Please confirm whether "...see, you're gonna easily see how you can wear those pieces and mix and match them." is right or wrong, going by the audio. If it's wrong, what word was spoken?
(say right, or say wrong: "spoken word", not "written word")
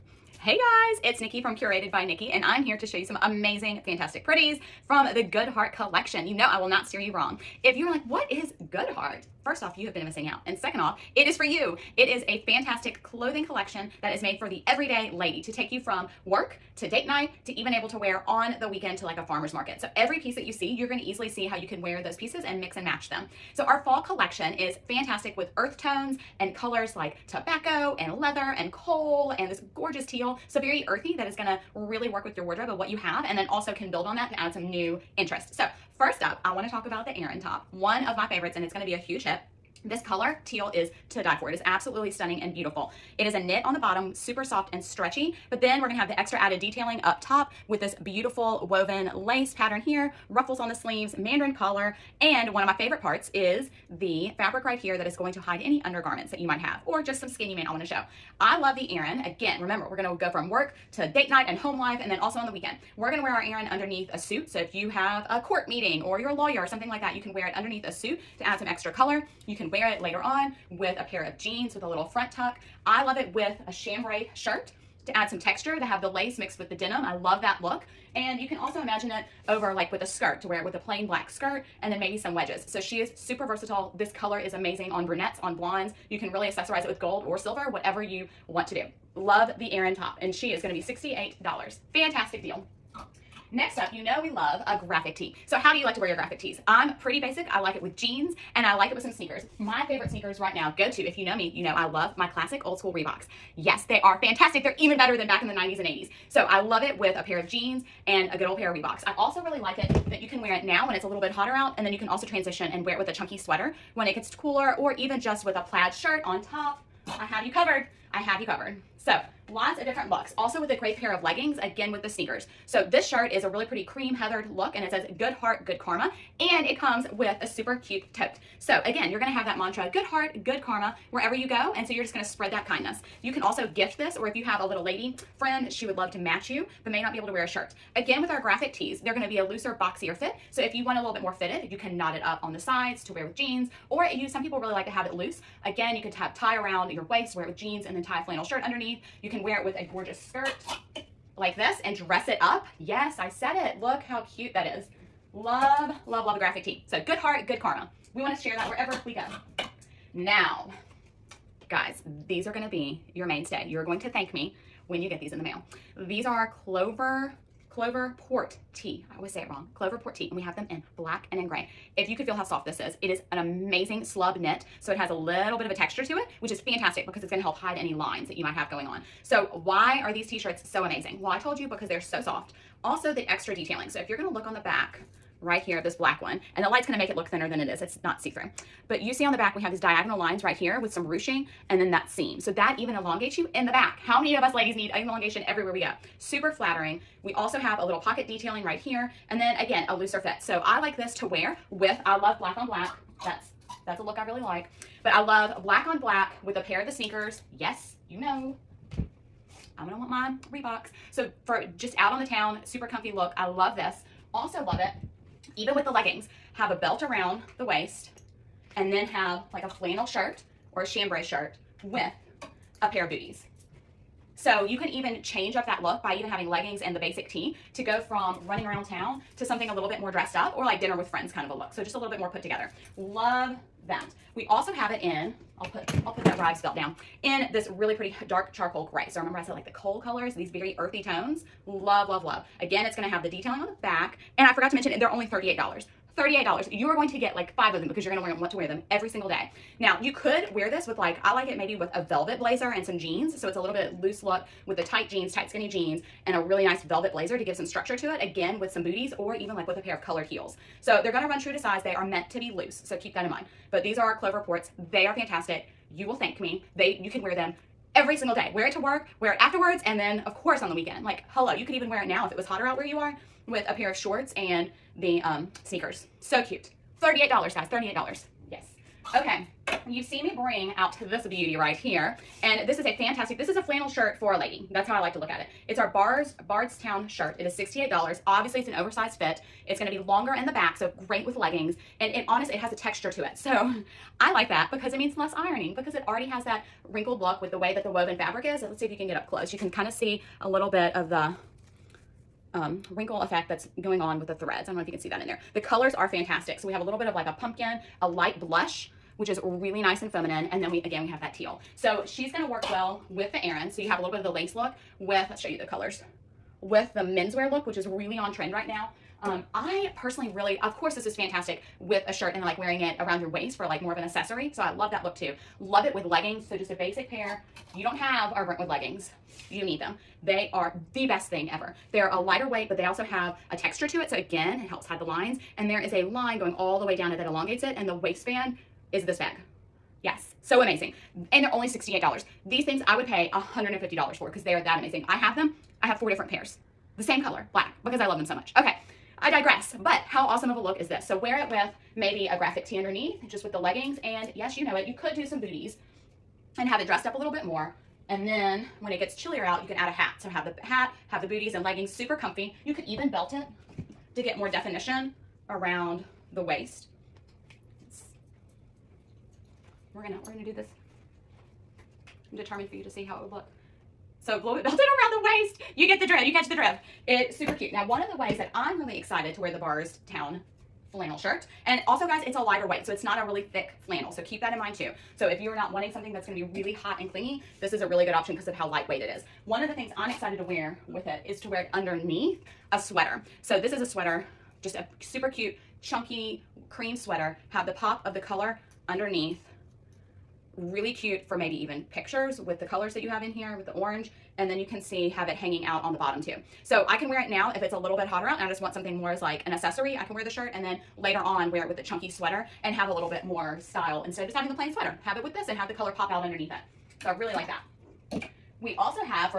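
right.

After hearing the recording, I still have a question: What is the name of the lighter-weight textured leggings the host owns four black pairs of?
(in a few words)
Brentwood leggings.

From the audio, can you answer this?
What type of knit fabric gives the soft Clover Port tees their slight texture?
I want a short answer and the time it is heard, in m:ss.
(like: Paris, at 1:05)
Slub knit, at 2:54.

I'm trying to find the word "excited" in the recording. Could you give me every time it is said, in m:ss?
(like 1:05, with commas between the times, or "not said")
6:18, 6:30.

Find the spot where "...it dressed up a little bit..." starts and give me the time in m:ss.
5:56.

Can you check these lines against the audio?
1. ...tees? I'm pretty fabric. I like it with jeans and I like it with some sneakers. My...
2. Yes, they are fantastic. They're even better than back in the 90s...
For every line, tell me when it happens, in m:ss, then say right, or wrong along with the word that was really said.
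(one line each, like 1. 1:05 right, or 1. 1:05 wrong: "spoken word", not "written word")
1. 1:36 wrong: "basic", not "fabric"
2. 1:43 right.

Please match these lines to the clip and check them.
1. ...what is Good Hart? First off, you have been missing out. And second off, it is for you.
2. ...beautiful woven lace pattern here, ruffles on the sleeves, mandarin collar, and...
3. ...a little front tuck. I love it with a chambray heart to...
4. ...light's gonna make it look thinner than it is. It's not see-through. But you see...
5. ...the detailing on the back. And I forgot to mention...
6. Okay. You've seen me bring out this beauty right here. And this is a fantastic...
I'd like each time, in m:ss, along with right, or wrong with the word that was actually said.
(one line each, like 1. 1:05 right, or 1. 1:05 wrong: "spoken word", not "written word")
1. 0:08 right
2. 0:48 right
3. 1:11 wrong: "shirt", not "heart"
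4. 3:06 right
5. 4:03 right
6. 4:39 right.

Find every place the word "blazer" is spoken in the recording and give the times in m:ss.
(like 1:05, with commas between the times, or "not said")
4:12, 4:17.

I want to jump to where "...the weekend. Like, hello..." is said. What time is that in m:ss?
4:30.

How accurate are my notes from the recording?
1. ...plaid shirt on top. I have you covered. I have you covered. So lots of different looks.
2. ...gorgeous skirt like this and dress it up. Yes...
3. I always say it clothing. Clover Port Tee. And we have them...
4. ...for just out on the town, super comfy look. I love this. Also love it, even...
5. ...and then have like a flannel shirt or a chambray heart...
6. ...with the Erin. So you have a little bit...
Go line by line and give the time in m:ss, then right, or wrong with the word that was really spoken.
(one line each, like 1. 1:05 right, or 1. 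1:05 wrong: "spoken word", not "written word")
1. 1:55 right
2. 2:29 right
3. 2:49 wrong: "wrong", not "clothing"
4. 3:31 right
5. 3:38 wrong: "shirt", not "heart"
6. 5:13 right.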